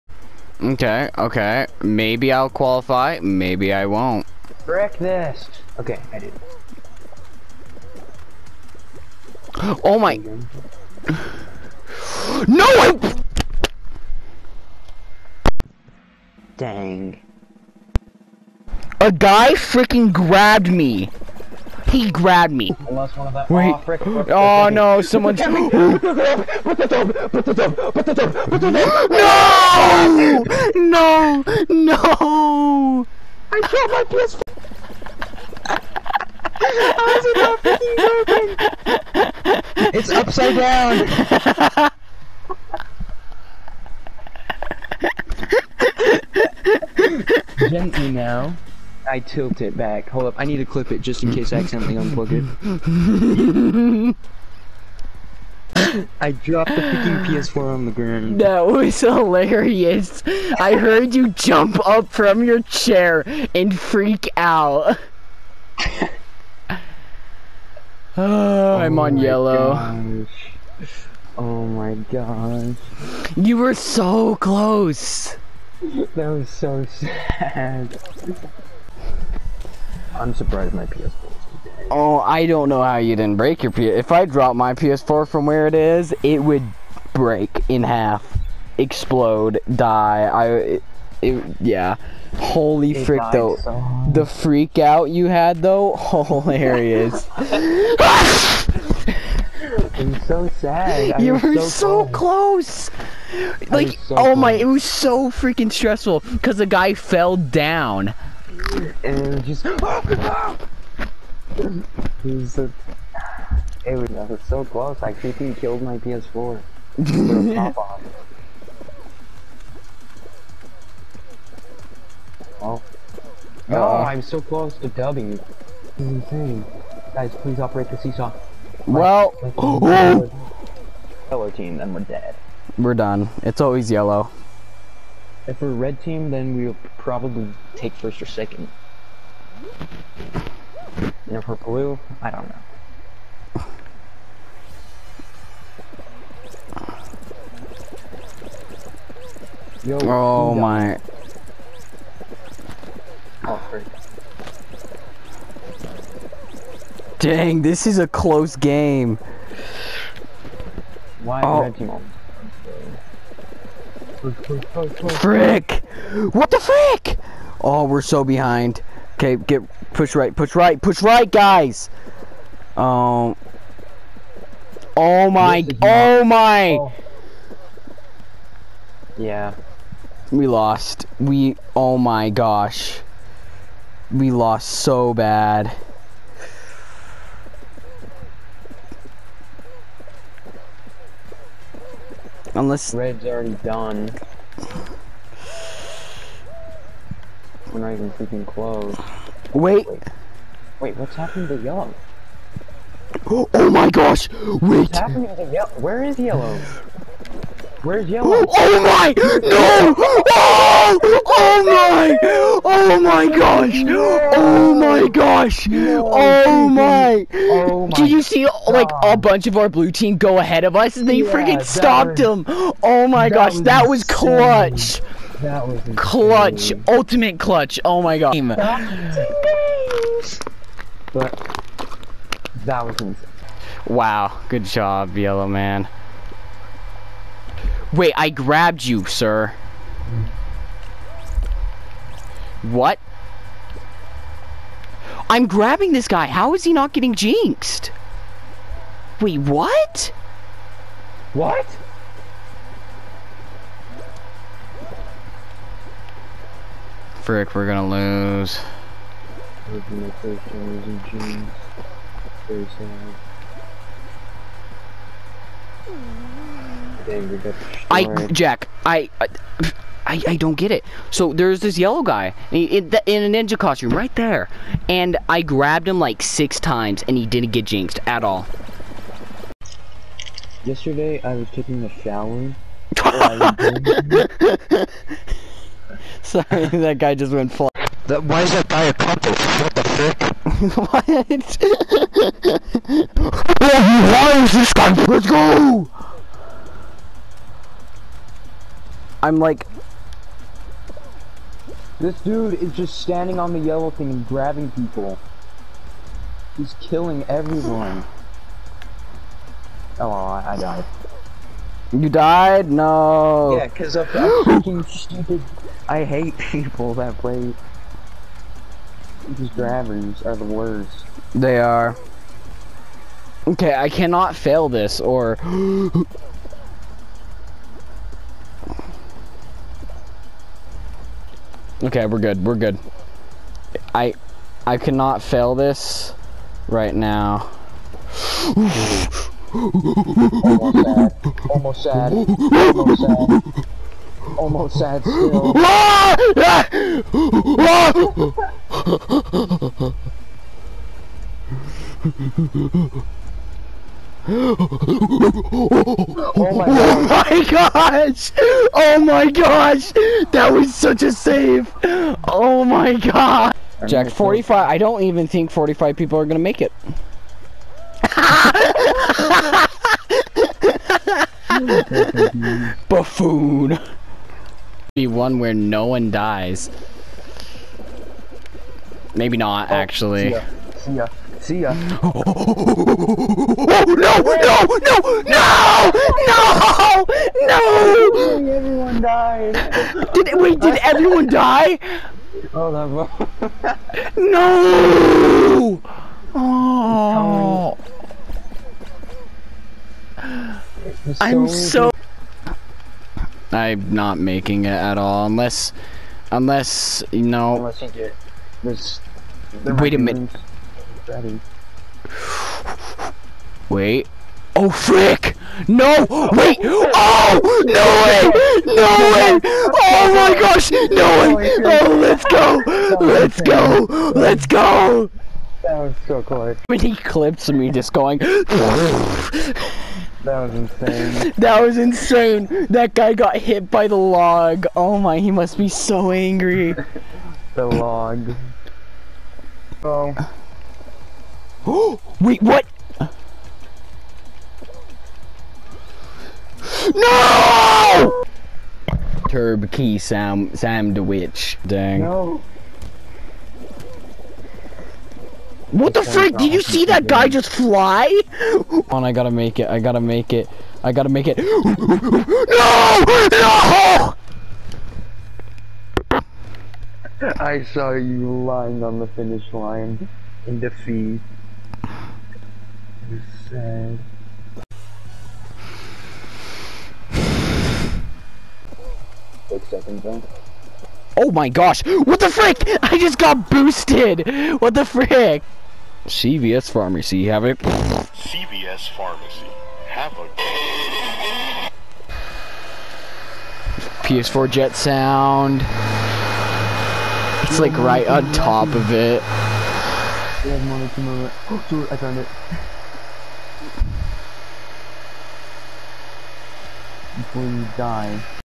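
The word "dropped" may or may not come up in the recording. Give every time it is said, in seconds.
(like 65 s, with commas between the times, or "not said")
56 s, 84 s.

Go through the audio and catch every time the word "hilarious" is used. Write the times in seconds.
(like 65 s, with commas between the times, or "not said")
58 s, 96 s.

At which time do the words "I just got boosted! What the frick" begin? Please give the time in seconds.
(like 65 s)
482 s.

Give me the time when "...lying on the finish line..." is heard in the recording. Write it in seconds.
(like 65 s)
468 s.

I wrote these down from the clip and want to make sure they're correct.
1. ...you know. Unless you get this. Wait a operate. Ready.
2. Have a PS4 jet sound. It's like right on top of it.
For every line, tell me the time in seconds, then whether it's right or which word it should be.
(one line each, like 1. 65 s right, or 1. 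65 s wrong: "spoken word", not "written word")
1. 407 s wrong: "minute", not "operate"
2. 489 s right.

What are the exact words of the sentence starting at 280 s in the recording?
Yesterday, I was taking a shower.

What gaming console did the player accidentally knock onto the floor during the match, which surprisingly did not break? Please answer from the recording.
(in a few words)
PS4.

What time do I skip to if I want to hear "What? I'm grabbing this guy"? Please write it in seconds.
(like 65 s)
242 s.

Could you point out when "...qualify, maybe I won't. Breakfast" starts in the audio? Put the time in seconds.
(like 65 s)
2 s.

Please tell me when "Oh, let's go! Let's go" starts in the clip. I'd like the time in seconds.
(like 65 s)
421 s.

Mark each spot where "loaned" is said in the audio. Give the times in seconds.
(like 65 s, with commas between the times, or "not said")
not said.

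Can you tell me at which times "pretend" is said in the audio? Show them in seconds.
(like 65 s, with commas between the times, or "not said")
not said.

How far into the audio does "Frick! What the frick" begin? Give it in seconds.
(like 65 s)
165 s.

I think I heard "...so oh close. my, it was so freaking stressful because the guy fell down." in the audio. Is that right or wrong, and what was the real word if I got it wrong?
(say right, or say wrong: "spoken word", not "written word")
right.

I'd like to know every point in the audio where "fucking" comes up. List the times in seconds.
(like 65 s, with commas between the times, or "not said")
314 s.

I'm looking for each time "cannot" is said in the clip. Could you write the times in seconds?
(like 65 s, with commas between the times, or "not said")
323 s, 334 s.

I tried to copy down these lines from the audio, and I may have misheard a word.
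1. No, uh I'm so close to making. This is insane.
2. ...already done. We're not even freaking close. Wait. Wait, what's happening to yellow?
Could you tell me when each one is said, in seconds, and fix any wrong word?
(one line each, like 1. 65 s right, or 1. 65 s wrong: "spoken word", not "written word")
1. 123 s wrong: "dubbing", not "making"
2. 193 s right.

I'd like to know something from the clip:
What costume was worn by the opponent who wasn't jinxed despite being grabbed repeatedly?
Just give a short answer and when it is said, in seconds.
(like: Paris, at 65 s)
Ninja costume, at 273 s.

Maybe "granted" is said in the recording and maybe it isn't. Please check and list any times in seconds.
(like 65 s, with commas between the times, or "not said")
not said.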